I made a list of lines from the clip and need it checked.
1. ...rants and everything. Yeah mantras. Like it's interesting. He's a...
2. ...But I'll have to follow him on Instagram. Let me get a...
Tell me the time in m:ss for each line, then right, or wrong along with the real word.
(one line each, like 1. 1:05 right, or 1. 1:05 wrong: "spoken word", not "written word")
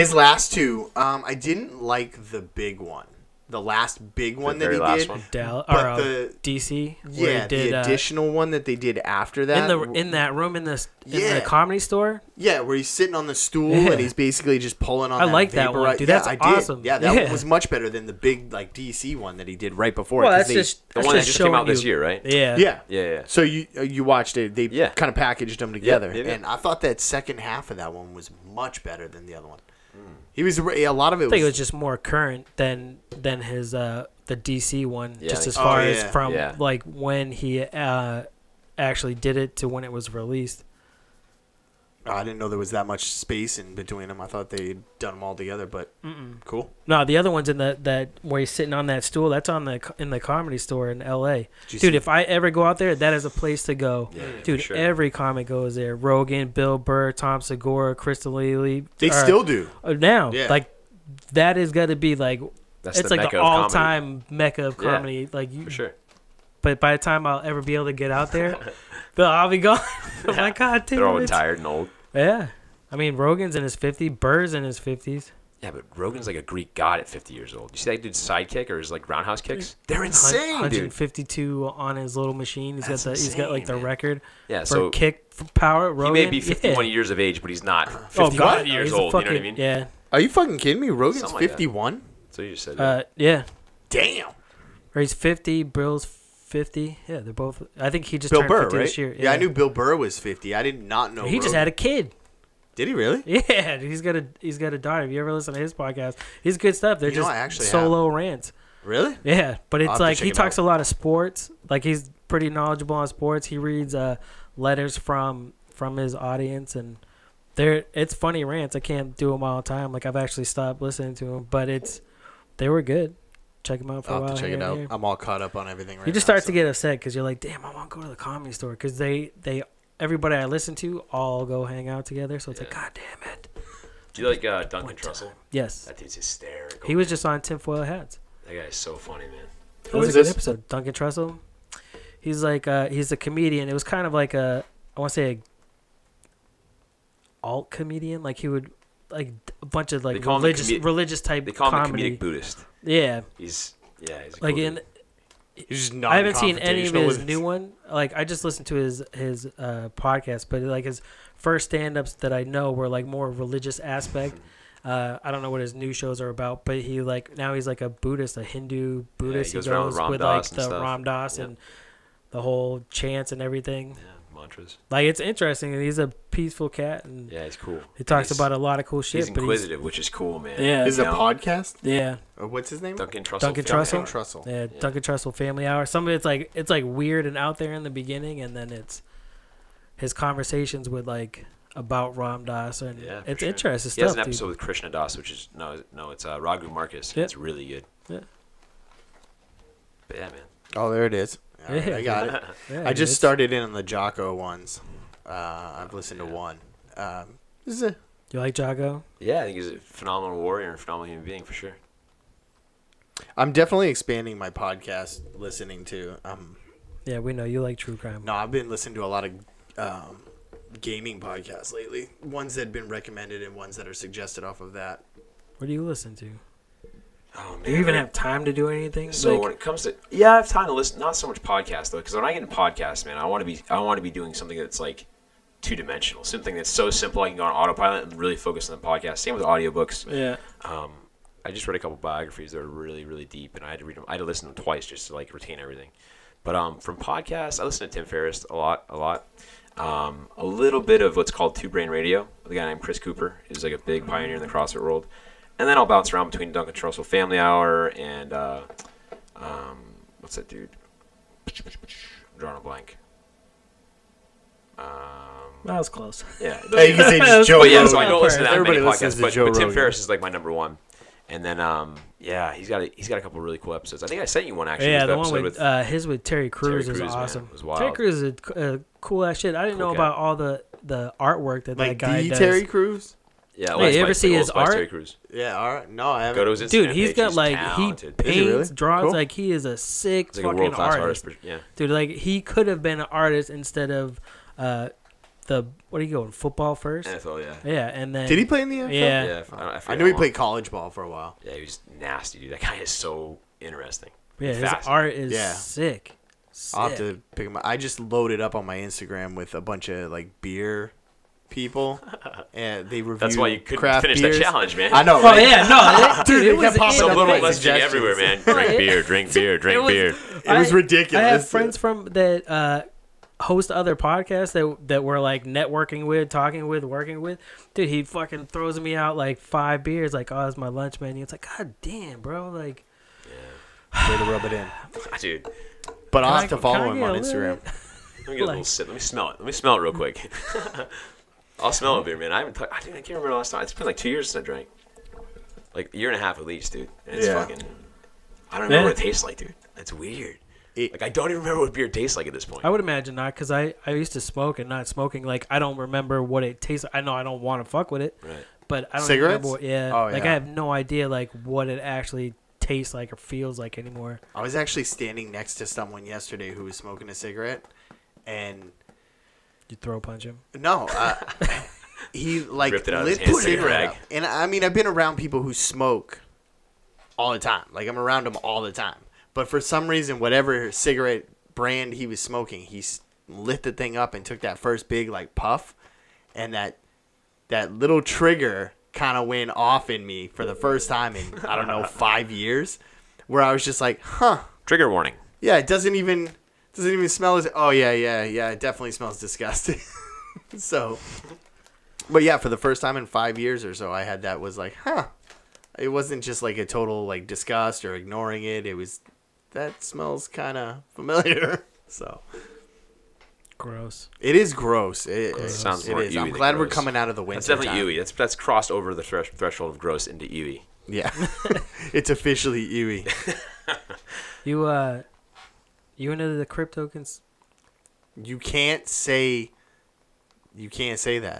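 1. 2:52 wrong: "chants", not "rants"
2. 5:36 right.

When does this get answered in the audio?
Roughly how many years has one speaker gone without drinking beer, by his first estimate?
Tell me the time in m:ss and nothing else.
5:43.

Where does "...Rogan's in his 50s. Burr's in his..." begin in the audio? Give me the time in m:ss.
1:13.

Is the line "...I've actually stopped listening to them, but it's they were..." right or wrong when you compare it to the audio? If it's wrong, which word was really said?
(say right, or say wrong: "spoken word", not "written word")
right.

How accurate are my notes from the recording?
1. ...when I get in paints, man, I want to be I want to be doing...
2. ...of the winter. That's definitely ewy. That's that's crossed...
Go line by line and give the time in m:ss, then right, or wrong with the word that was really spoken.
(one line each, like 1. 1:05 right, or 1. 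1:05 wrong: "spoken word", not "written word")
1. 3:52 wrong: "podcasts", not "paints"
2. 6:57 right.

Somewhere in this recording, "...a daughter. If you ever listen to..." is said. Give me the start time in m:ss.
1:44.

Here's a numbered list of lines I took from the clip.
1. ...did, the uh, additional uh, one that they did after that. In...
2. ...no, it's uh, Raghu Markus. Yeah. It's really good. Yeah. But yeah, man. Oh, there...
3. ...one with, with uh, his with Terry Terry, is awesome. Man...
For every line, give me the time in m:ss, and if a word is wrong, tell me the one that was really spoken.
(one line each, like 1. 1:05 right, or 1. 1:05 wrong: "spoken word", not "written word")
1. 0:07 right
2. 3:15 right
3. 4:35 wrong: "Crews", not "Terry".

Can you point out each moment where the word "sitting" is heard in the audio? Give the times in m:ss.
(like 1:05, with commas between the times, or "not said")
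0:12, 0:48.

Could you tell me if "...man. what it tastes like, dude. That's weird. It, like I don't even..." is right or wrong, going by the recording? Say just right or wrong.
right.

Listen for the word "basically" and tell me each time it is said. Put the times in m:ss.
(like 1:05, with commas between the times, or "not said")
0:14.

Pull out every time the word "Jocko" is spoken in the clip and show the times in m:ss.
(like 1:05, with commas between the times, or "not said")
3:23, 3:28.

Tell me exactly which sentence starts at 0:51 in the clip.
Dude, if I ever go out there, that is a place to go.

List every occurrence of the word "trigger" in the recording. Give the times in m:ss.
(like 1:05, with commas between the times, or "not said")
6:28, 6:34.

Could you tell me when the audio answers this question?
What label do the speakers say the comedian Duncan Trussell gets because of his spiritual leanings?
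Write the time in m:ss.
2:32.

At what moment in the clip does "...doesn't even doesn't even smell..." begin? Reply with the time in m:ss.
6:35.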